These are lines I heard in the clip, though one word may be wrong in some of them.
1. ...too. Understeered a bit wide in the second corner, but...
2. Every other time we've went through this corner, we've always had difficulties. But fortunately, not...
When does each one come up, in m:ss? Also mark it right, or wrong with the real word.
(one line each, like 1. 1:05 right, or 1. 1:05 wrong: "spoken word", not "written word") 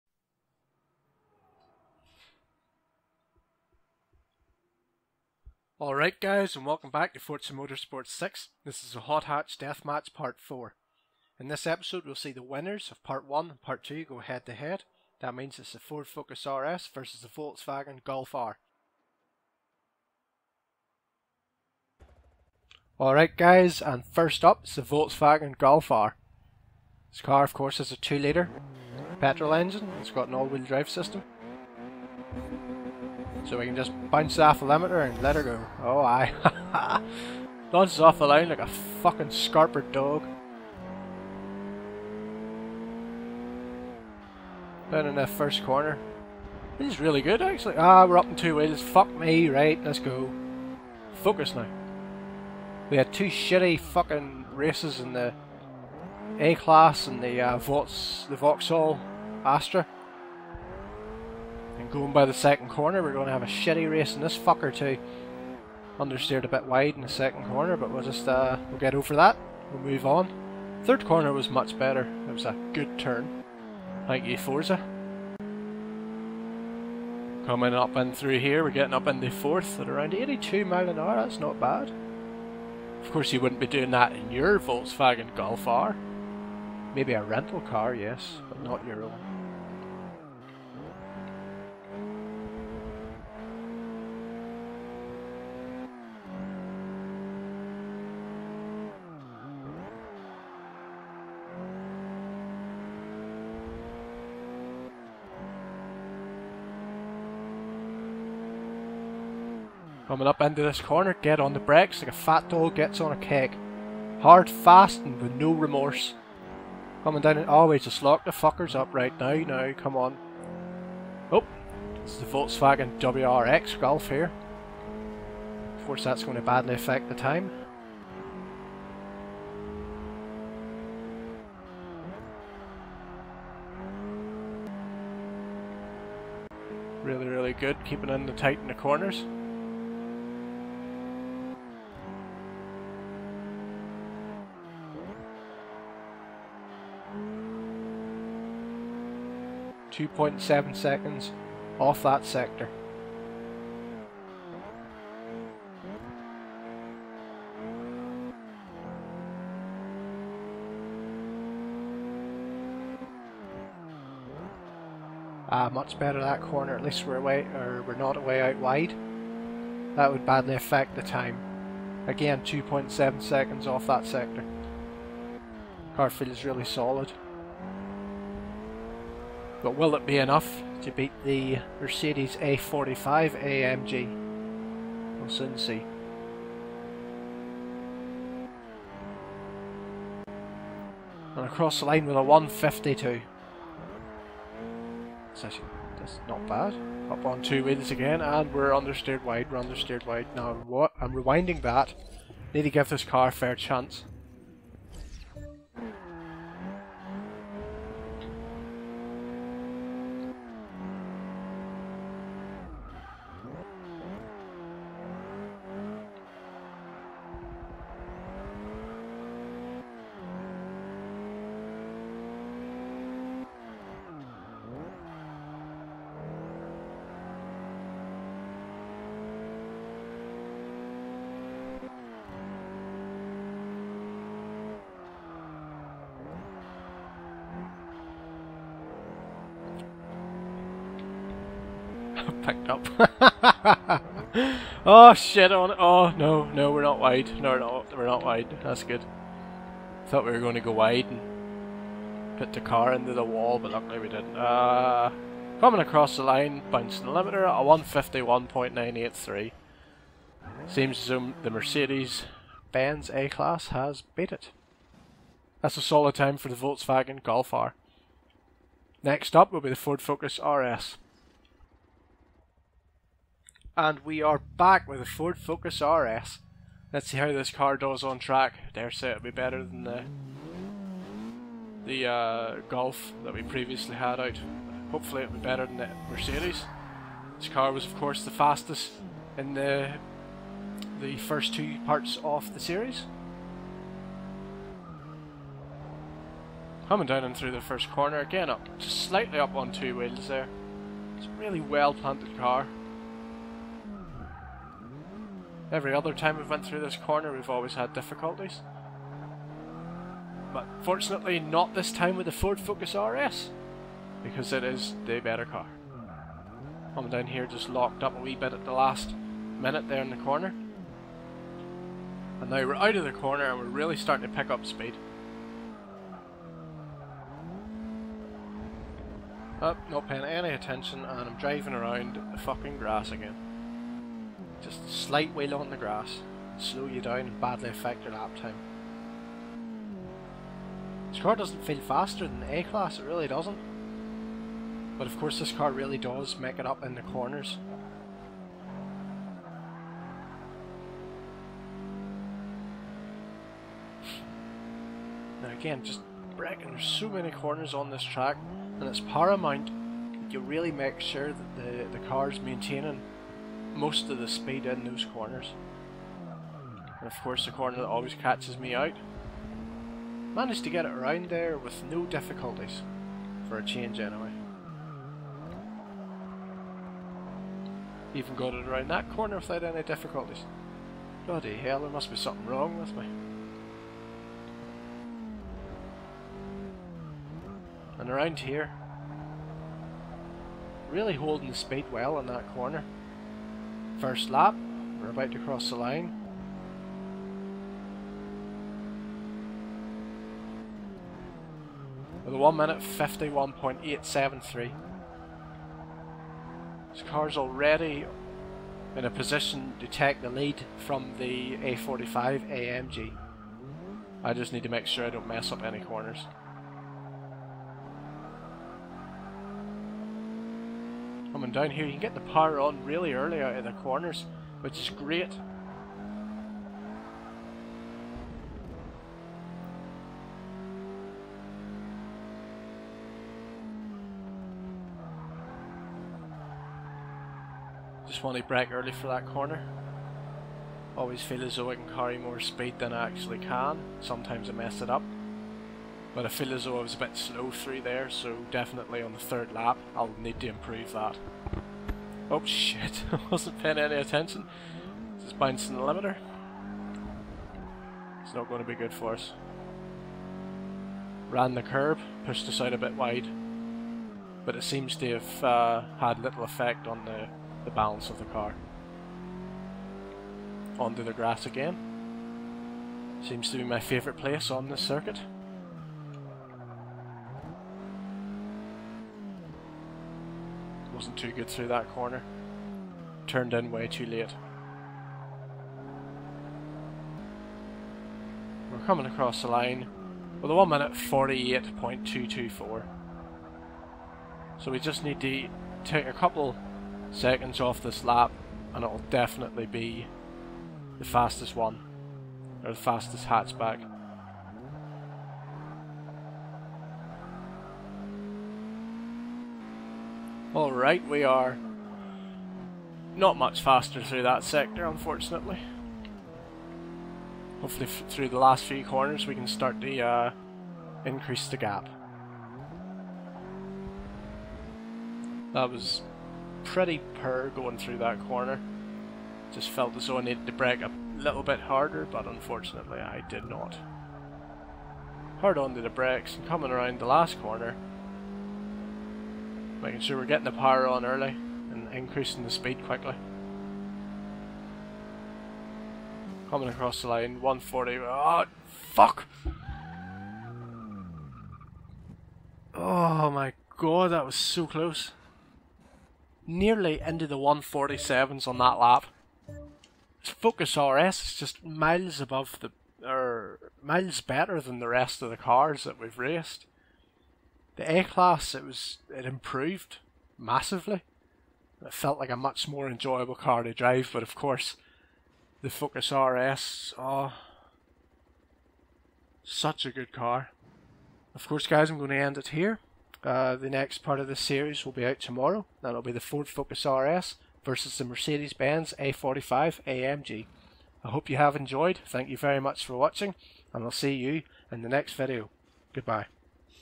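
1. 1:04 right
2. 5:05 right.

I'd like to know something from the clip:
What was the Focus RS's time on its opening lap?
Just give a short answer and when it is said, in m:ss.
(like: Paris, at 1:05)
1:51.873, at 6:42.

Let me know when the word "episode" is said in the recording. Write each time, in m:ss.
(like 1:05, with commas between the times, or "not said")
0:11.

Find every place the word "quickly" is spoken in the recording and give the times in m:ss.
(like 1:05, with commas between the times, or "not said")
9:02.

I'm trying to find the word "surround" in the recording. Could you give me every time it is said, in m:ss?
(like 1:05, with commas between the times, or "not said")
not said.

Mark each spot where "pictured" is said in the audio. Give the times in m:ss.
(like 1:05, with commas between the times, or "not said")
not said.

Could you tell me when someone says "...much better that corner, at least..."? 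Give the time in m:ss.
2:45.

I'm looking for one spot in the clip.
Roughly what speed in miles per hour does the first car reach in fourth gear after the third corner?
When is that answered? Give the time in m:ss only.
1:20.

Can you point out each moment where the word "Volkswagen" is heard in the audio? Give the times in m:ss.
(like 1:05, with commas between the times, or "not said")
0:17, 0:24, 1:24, 2:02, 4:26.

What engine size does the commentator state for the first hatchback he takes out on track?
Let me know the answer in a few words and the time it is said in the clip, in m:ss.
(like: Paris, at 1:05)
2 litre, at 0:27.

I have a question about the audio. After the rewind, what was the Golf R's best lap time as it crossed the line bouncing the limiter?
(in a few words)
151.983.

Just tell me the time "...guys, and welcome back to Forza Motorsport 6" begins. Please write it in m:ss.
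0:06.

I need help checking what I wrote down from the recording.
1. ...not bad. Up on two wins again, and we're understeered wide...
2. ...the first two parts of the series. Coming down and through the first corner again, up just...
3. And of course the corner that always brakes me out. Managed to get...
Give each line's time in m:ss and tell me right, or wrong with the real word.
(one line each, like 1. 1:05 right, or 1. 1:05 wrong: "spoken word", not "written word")
1. 3:16 right
2. 4:50 right
3. 6:06 wrong: "catches", not "brakes".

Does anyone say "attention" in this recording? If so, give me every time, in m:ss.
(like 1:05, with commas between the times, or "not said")
5:30, 7:33.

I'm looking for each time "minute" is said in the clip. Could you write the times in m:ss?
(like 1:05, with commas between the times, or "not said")
5:19, 6:42, 8:10.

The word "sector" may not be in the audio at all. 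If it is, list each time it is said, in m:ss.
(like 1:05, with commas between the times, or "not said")
2:32, 2:54, 8:34.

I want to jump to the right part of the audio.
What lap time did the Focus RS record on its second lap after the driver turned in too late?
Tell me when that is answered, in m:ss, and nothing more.
8:10.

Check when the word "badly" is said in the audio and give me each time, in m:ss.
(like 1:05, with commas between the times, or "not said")
2:06, 2:50, 5:37.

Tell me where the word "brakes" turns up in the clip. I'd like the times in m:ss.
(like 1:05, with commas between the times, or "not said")
1:51, 8:50, 8:55.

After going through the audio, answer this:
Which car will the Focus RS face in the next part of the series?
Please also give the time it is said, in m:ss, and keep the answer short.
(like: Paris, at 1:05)
Mercedes Benz A45 AMG, at 9:48.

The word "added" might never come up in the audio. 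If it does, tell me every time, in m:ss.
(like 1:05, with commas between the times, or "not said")
not said.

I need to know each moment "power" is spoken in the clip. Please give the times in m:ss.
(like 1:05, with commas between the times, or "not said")
7:02, 9:00.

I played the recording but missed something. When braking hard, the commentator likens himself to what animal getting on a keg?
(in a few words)
fat dog.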